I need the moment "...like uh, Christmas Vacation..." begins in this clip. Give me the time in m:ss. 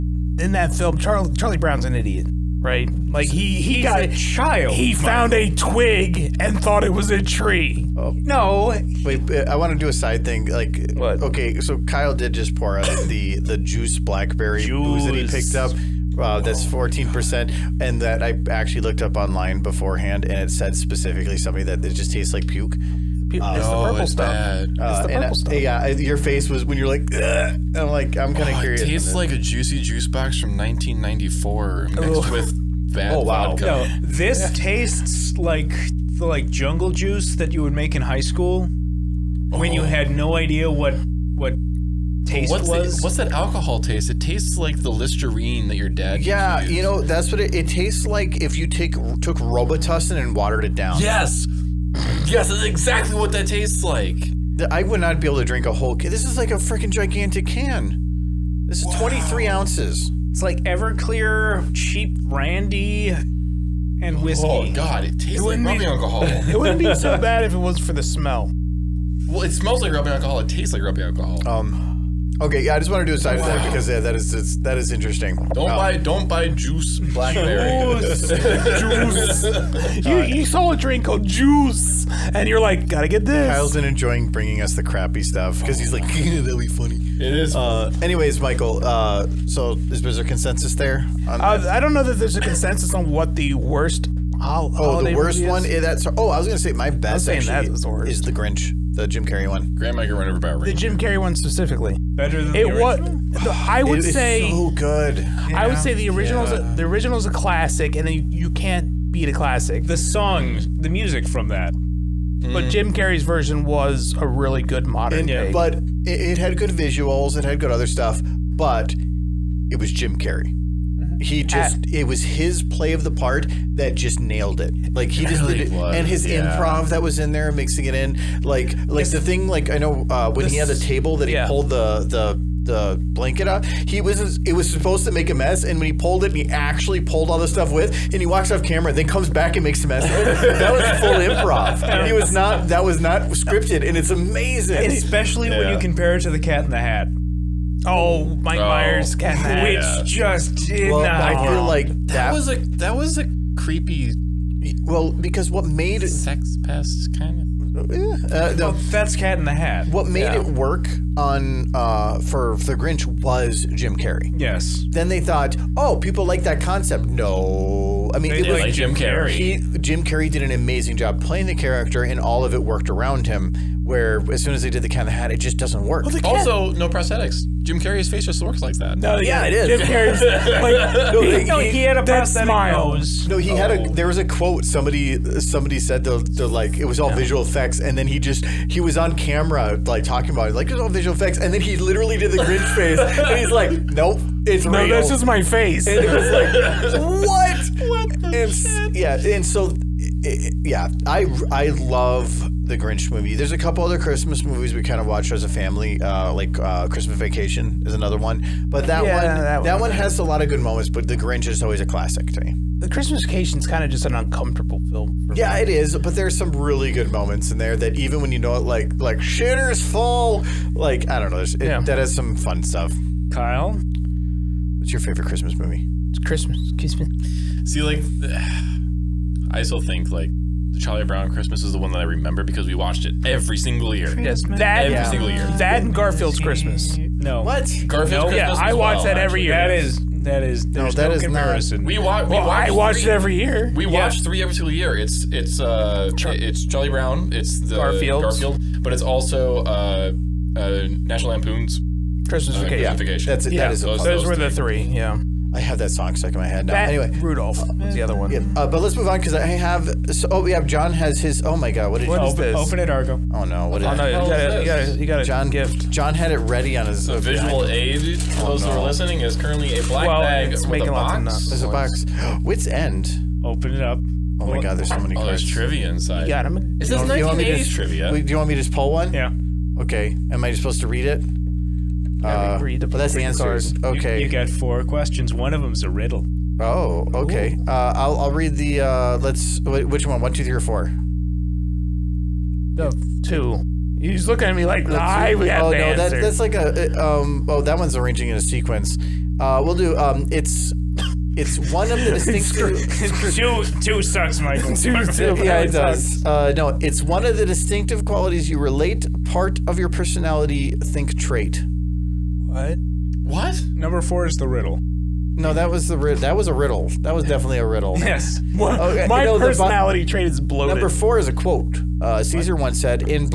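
3:26.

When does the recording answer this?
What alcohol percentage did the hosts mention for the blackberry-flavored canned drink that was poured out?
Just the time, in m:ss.
0:16.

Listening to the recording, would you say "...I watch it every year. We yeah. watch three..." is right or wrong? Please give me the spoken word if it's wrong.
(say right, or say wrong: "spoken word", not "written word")
right.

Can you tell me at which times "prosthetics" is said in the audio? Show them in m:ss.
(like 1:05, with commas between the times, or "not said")
2:56, 3:02.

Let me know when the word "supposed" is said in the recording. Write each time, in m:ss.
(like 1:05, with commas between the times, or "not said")
2:14, 4:40.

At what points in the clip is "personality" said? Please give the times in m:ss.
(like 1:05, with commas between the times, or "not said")
5:09, 5:19.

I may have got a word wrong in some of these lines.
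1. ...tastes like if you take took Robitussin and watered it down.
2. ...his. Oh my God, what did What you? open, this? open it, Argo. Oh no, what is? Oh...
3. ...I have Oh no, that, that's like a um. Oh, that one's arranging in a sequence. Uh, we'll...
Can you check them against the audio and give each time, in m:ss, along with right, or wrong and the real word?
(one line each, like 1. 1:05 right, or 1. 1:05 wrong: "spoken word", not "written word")
1. 0:47 right
2. 4:21 right
3. 4:54 right.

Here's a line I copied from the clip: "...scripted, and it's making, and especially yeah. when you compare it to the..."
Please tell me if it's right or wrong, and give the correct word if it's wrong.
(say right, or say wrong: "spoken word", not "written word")
wrong: "amazing", not "making".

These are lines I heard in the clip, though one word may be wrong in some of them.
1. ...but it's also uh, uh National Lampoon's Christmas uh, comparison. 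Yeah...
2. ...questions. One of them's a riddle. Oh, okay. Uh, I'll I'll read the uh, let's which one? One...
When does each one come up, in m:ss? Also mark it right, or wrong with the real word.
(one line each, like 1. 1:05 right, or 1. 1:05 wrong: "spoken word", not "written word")
1. 4:08 wrong: "vacation", not "comparison"
2. 4:44 right.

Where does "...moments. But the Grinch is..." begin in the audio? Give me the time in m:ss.
3:30.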